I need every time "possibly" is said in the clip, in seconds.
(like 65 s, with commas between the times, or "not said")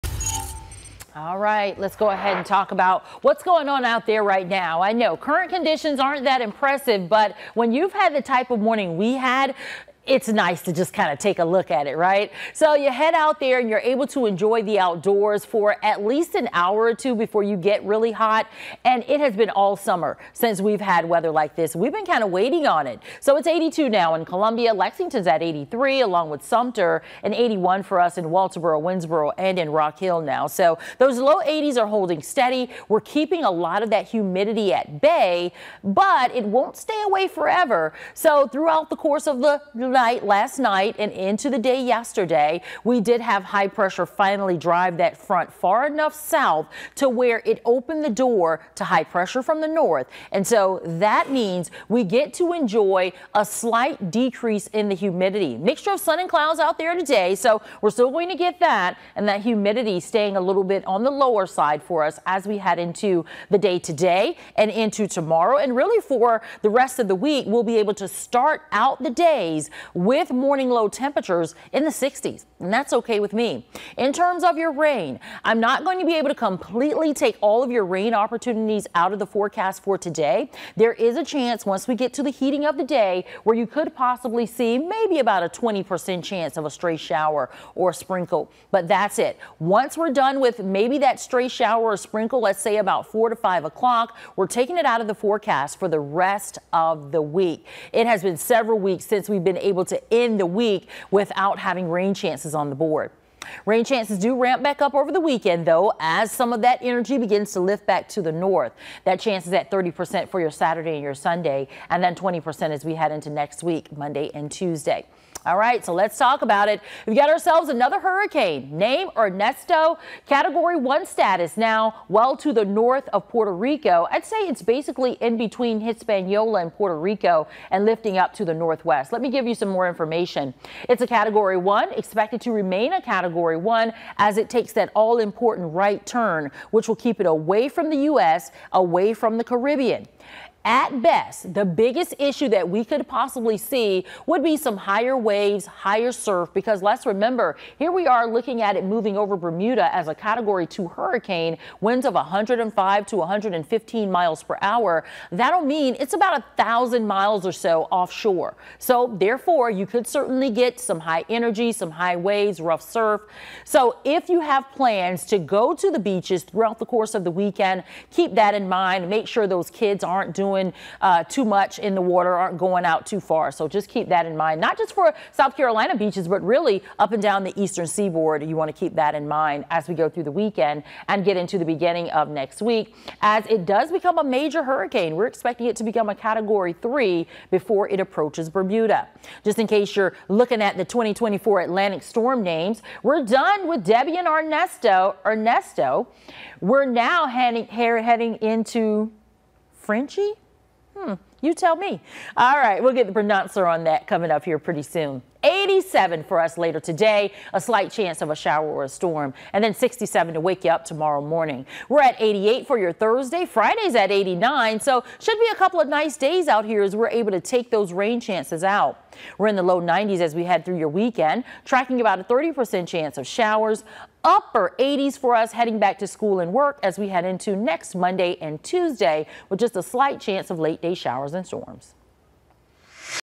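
83 s, 143 s.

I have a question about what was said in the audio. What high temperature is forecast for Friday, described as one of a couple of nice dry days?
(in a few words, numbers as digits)
89.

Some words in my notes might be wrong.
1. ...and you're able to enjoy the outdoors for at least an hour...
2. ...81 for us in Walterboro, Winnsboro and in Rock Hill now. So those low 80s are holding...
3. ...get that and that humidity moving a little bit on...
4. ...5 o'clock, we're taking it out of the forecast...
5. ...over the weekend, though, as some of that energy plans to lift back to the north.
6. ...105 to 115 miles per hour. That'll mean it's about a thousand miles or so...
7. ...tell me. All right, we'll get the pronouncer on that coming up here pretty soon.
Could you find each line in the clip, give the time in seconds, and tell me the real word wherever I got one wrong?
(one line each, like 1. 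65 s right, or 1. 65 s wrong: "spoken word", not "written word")
1. 13 s right
2. 27 s right
3. 58 s wrong: "staying", not "moving"
4. 93 s right
5. 104 s wrong: "begins", not "plans"
6. 152 s right
7. 201 s right.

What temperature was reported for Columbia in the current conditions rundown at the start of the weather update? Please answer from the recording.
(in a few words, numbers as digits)
82.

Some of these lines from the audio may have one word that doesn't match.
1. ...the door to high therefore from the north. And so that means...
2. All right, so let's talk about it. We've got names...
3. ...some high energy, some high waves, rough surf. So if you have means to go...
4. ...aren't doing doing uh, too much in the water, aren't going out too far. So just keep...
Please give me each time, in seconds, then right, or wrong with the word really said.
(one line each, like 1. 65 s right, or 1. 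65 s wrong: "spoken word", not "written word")
1. 48 s wrong: "pressure", not "therefore"
2. 115 s wrong: "ourselves", not "names"
3. 160 s wrong: "plans", not "means"
4. 170 s right.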